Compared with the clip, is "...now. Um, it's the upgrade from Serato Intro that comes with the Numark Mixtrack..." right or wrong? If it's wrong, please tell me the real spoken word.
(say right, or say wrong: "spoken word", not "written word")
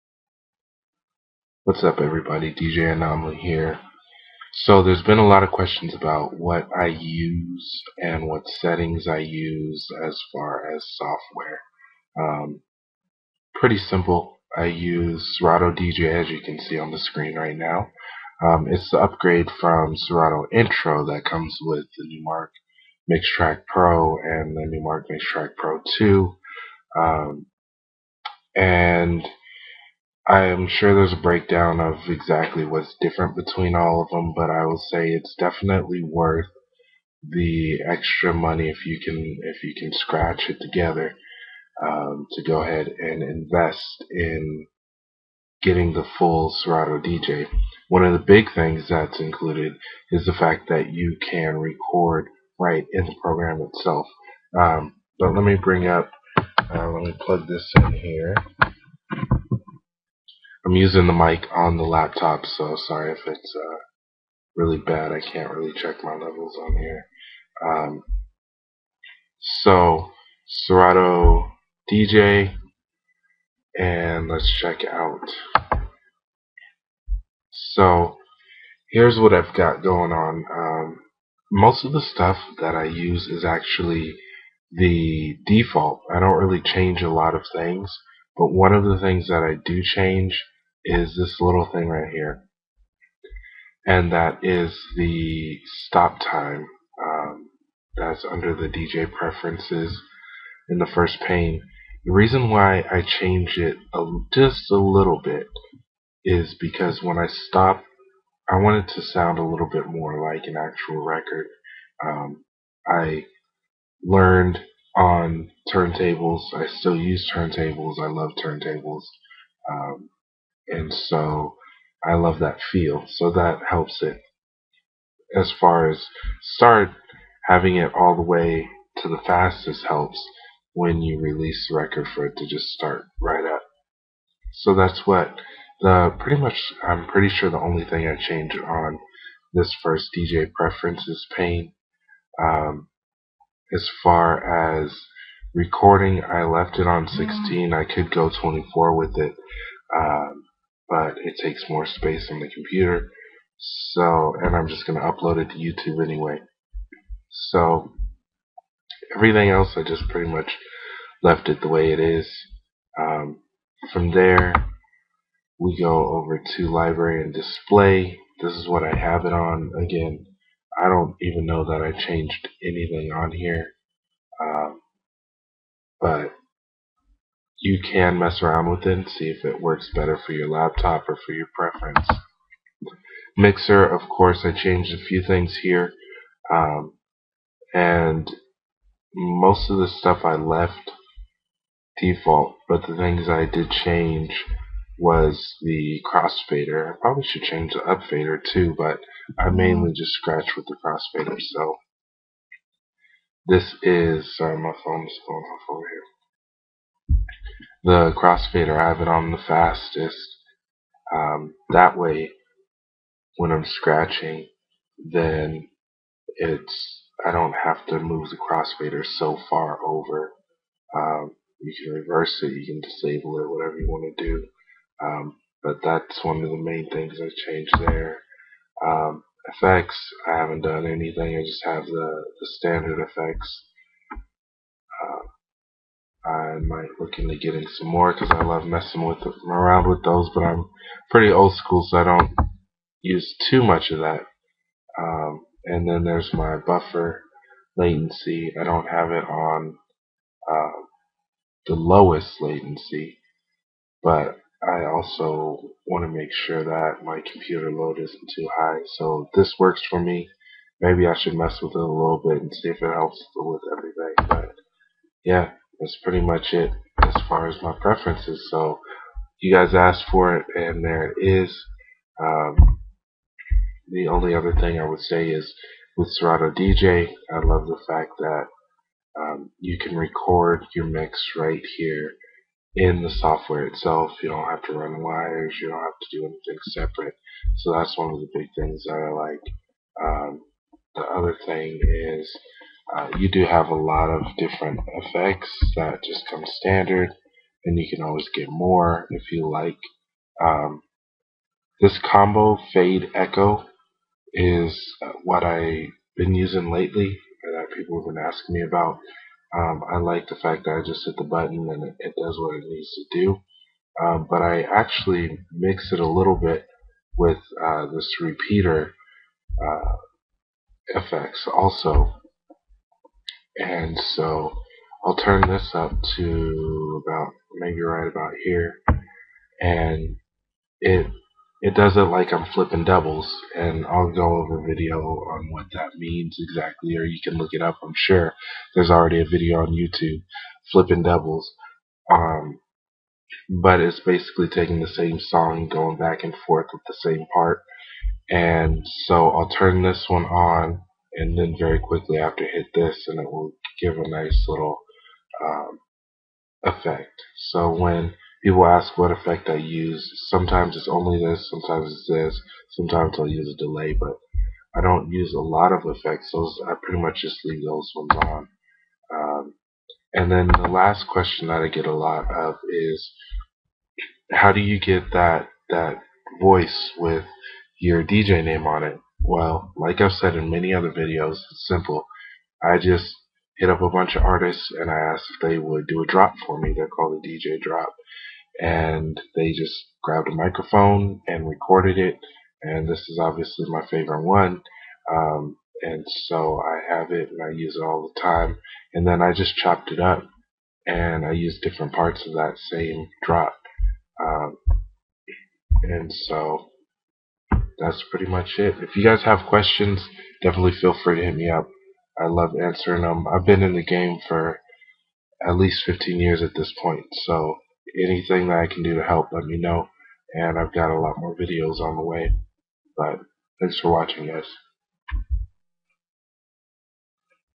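right.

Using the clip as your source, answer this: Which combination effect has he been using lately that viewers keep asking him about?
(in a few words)
Fade Echo.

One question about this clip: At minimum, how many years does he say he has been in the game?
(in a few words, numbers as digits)
15.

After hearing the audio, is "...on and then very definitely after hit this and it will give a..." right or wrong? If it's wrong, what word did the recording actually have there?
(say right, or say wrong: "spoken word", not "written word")
wrong: "quickly", not "definitely".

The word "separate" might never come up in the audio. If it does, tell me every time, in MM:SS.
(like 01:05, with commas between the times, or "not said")
04:46.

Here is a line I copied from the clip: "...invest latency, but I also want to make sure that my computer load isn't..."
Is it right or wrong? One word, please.
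wrong.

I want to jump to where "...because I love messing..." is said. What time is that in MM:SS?
03:58.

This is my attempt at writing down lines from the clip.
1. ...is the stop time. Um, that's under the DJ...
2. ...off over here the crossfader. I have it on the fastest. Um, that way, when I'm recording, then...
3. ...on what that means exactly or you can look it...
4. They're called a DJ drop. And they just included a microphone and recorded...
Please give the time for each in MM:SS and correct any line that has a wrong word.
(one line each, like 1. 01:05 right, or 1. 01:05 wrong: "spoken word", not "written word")
1. 01:34 right
2. 03:25 wrong: "scratching", not "recording"
3. 05:34 right
4. 06:26 wrong: "grabbed", not "included".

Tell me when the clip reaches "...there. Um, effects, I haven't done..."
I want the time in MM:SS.
03:47.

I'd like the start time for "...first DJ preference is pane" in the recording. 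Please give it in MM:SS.
02:19.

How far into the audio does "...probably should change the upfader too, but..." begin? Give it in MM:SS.
03:16.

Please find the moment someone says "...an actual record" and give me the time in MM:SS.
01:50.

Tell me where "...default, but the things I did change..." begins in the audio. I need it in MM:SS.
03:12.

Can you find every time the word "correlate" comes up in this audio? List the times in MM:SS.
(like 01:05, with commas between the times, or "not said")
not said.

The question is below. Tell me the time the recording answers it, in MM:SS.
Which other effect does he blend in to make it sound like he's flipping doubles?
05:18.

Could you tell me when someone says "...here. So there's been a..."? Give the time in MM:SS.
00:03.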